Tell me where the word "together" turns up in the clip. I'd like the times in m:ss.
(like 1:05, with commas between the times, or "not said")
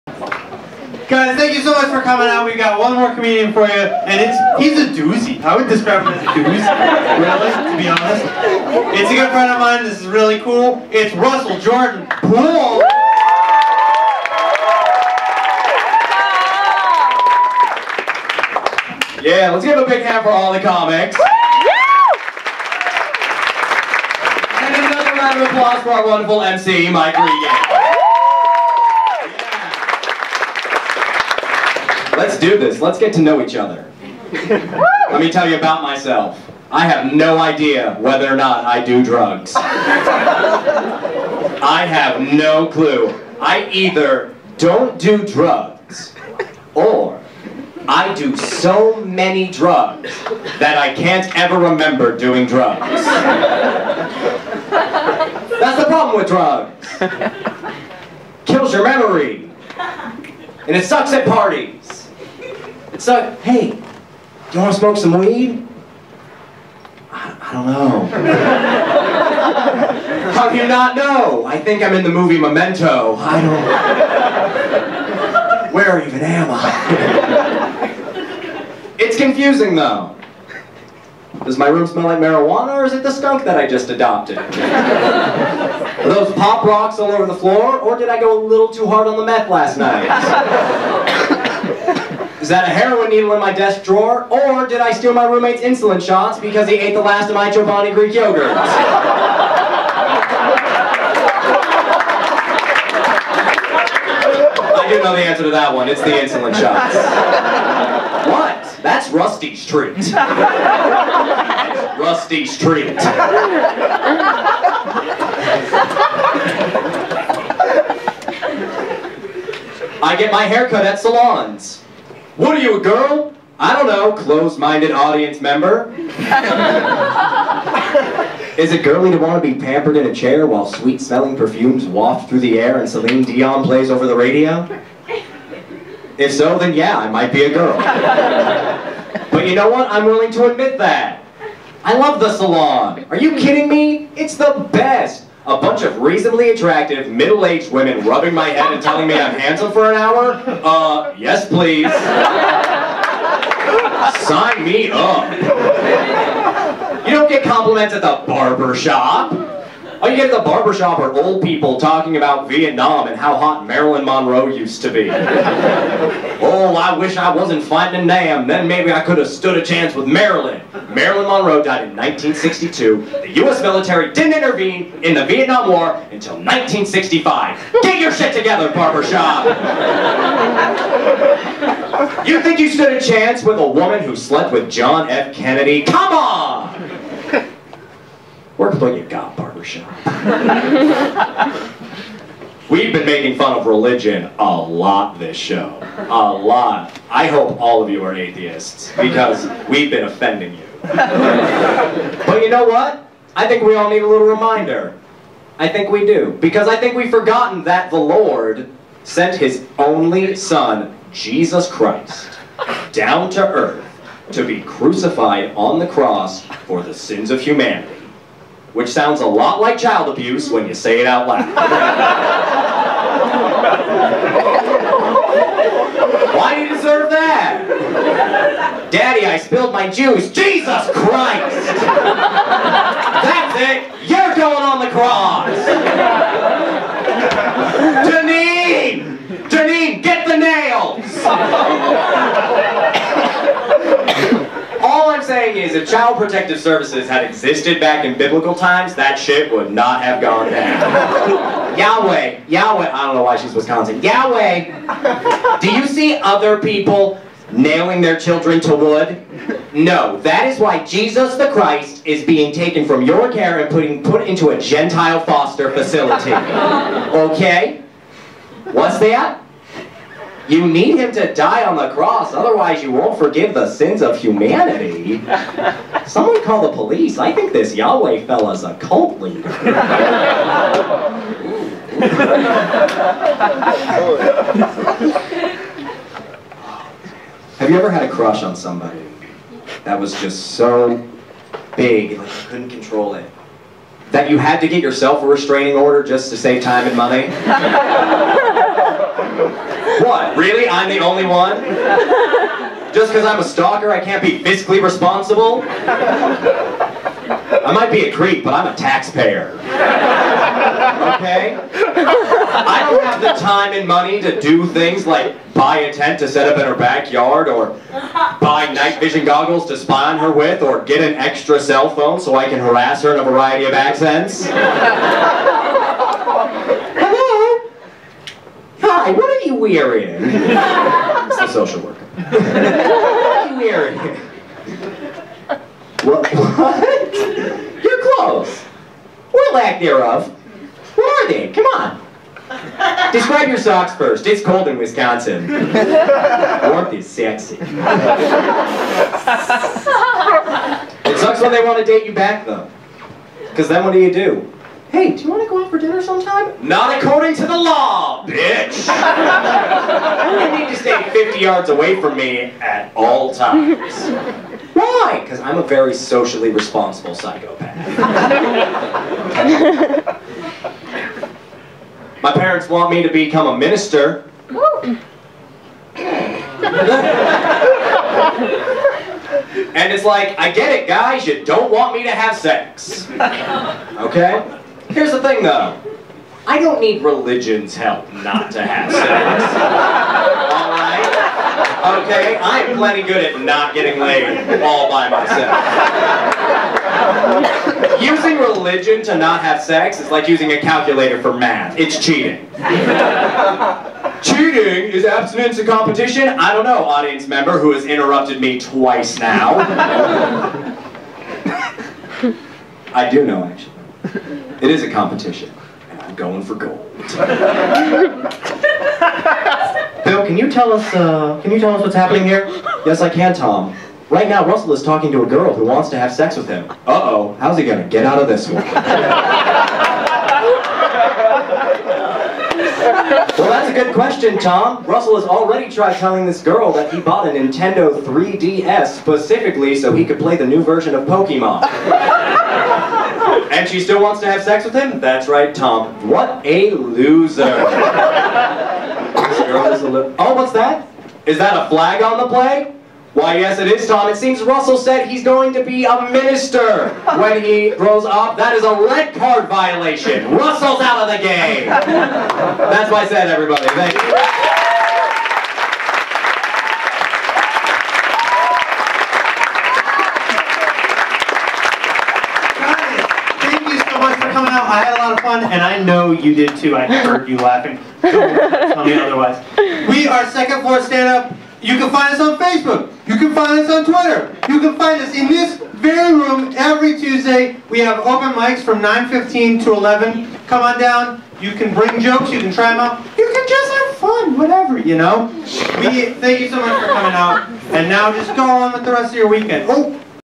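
2:58.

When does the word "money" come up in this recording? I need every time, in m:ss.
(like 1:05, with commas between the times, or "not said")
4:56, 5:13.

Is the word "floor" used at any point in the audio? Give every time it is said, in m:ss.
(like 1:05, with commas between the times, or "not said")
1:27, 8:00.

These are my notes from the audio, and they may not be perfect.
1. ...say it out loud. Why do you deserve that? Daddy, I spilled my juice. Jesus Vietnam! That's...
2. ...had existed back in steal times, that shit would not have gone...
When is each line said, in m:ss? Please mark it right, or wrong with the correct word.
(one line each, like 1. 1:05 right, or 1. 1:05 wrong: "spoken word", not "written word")
1. 3:40 wrong: "Christ", not "Vietnam"
2. 4:07 wrong: "biblical", not "steal".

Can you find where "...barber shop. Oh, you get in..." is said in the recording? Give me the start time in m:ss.
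2:38.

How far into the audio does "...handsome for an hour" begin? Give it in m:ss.
2:29.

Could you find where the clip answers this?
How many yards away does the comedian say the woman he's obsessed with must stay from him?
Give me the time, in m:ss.
6:01.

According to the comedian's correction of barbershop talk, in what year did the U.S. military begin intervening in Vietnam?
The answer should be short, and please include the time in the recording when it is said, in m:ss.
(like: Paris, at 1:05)
1965, at 2:56.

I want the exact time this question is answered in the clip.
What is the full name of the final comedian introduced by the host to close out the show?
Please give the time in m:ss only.
0:11.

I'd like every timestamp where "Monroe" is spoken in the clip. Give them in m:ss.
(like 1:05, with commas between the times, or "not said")
2:44, 2:51.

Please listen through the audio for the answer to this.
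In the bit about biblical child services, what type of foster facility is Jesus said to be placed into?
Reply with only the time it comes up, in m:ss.
4:24.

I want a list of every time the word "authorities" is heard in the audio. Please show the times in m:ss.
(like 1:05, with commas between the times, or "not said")
not said.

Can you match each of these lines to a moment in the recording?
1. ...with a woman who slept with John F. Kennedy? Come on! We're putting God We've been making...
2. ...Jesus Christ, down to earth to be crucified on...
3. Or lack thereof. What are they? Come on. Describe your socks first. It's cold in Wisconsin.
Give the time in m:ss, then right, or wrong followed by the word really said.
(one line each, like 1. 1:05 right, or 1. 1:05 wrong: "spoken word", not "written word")
1. 3:03 right
2. 3:31 right
3. 5:39 right.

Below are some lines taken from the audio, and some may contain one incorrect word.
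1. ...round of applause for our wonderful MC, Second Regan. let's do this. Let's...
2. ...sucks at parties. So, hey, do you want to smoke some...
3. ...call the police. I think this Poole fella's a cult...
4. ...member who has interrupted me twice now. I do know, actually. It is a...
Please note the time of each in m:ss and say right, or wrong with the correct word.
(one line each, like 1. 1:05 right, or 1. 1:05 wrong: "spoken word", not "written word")
1. 0:25 wrong: "Mike", not "Second"
2. 1:00 right
3. 4:36 wrong: "Yahweh", not "Poole"
4. 6:47 right.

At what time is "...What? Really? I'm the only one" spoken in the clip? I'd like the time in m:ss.
5:00.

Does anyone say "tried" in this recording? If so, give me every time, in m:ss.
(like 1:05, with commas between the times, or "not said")
7:15.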